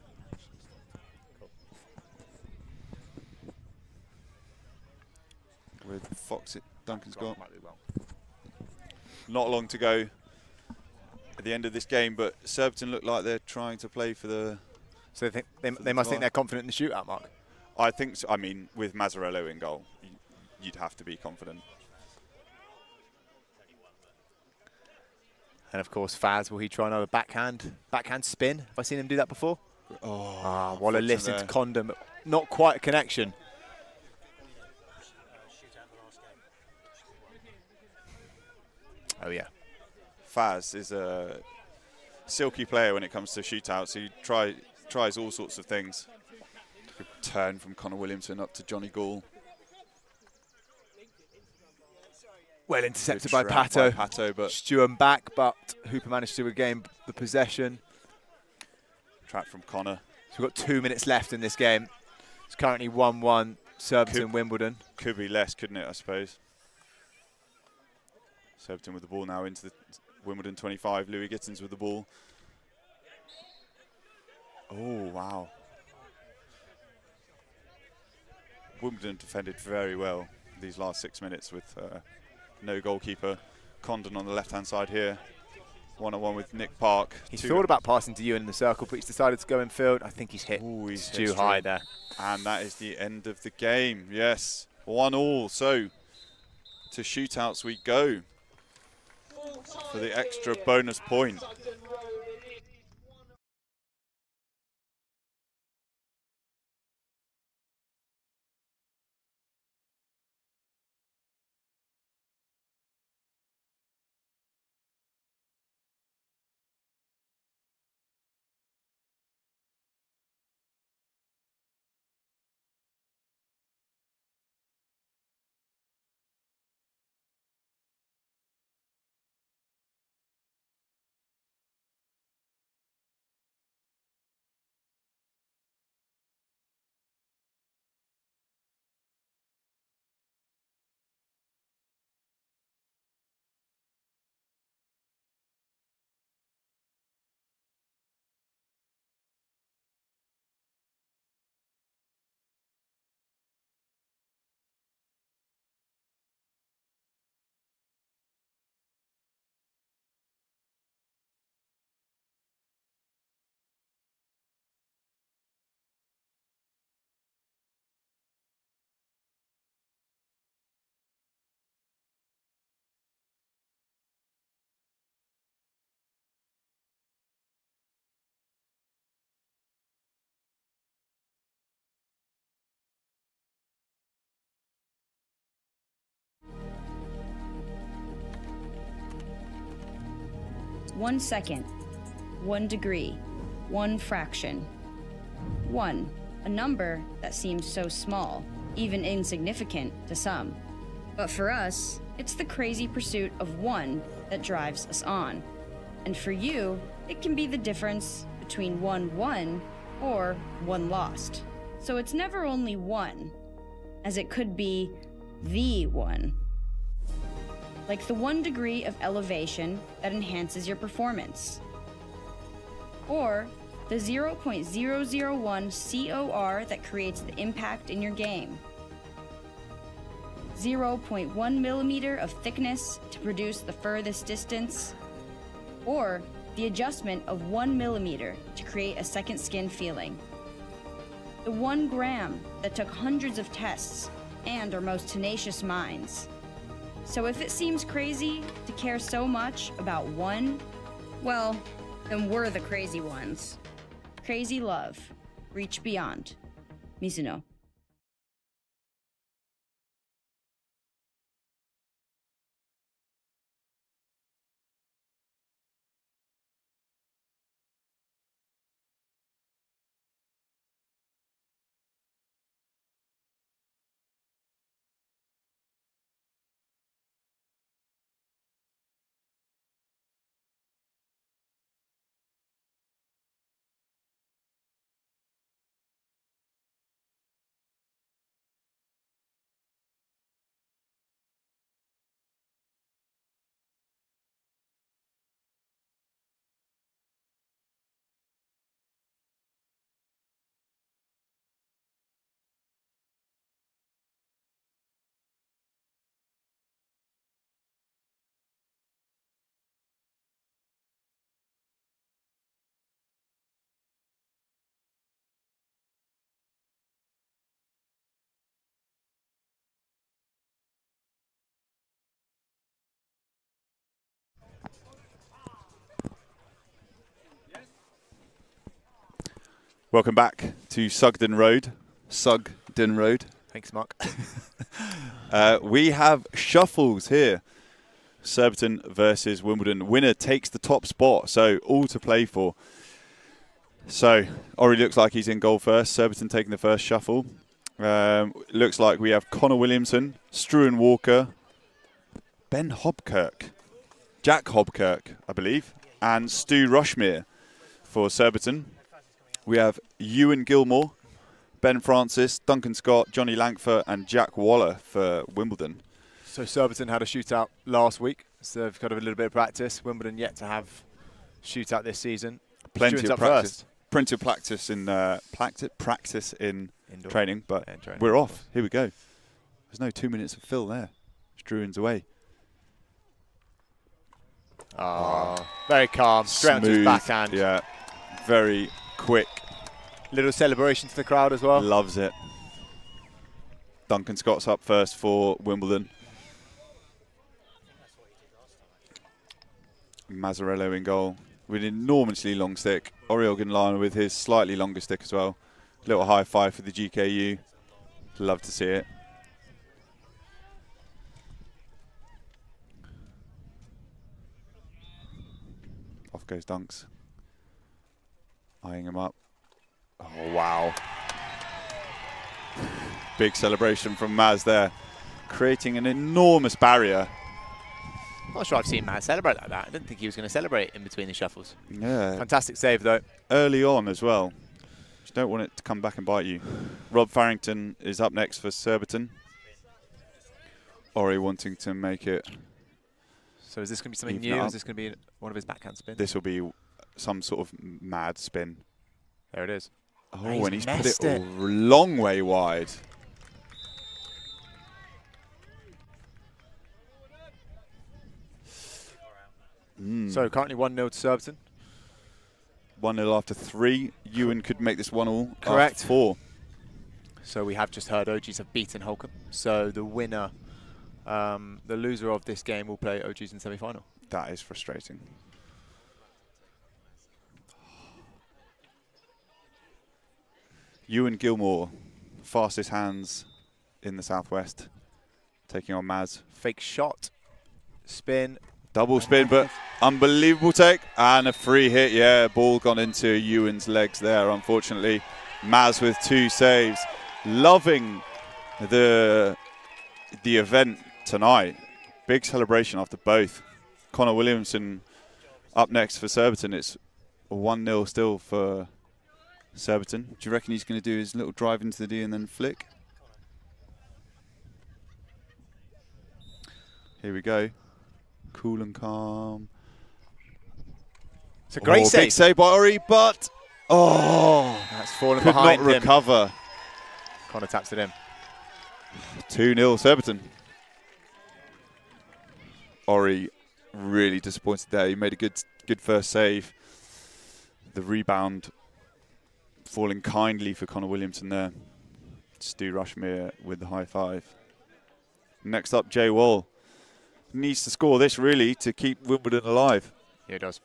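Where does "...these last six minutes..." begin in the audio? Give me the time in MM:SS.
01:20.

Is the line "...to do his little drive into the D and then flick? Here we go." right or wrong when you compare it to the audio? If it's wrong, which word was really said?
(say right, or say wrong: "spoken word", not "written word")
right.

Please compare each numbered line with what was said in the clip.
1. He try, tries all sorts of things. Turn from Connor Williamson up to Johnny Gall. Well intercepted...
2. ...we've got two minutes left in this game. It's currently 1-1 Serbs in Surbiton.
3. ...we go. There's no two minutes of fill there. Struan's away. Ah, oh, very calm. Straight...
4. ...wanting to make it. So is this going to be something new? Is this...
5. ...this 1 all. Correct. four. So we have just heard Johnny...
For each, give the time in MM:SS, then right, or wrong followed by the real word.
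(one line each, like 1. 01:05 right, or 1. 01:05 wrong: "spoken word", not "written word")
1. 00:43 right
2. 01:00 wrong: "Wimbledon", not "Surbiton"
3. 06:18 right
4. 07:21 right
5. 07:44 wrong: "OGs", not "Johnny".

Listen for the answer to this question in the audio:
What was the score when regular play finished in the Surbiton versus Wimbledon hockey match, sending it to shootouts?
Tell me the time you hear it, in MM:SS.
01:34.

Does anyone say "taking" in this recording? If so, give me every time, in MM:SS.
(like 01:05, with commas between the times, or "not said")
05:46, 08:05.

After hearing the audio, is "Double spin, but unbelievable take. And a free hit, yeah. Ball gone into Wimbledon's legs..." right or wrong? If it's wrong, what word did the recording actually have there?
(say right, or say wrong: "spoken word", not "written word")
wrong: "Ewan", not "Wimbledon".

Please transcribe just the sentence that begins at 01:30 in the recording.
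I think he's hit Ooh, he's too high there.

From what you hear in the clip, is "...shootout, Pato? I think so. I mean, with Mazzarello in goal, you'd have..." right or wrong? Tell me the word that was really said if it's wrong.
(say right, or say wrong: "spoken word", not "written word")
wrong: "Mark", not "Pato".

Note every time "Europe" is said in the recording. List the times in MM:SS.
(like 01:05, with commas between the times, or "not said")
not said.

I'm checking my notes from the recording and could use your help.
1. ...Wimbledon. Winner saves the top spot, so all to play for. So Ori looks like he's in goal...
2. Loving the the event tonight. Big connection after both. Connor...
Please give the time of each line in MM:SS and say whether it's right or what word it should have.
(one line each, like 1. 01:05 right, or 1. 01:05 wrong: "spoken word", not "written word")
1. 05:39 wrong: "takes", not "saves"
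2. 08:17 wrong: "celebration", not "connection".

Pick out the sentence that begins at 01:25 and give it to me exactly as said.
One-on-one -on -one with Nick Park.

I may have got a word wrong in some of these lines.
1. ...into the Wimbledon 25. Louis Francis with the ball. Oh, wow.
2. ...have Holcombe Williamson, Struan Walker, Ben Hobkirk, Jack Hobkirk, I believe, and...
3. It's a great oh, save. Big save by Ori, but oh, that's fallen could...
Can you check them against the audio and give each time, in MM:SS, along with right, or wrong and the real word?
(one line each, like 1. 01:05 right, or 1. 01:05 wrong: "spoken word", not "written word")
1. 01:09 wrong: "Gittins", not "Francis"
2. 05:49 wrong: "Connor", not "Holcombe"
3. 08:41 right.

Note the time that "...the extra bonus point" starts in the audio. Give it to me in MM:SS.
01:39.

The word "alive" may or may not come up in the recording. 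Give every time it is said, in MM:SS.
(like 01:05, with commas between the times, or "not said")
09:09.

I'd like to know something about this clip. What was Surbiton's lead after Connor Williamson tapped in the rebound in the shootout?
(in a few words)
2-0.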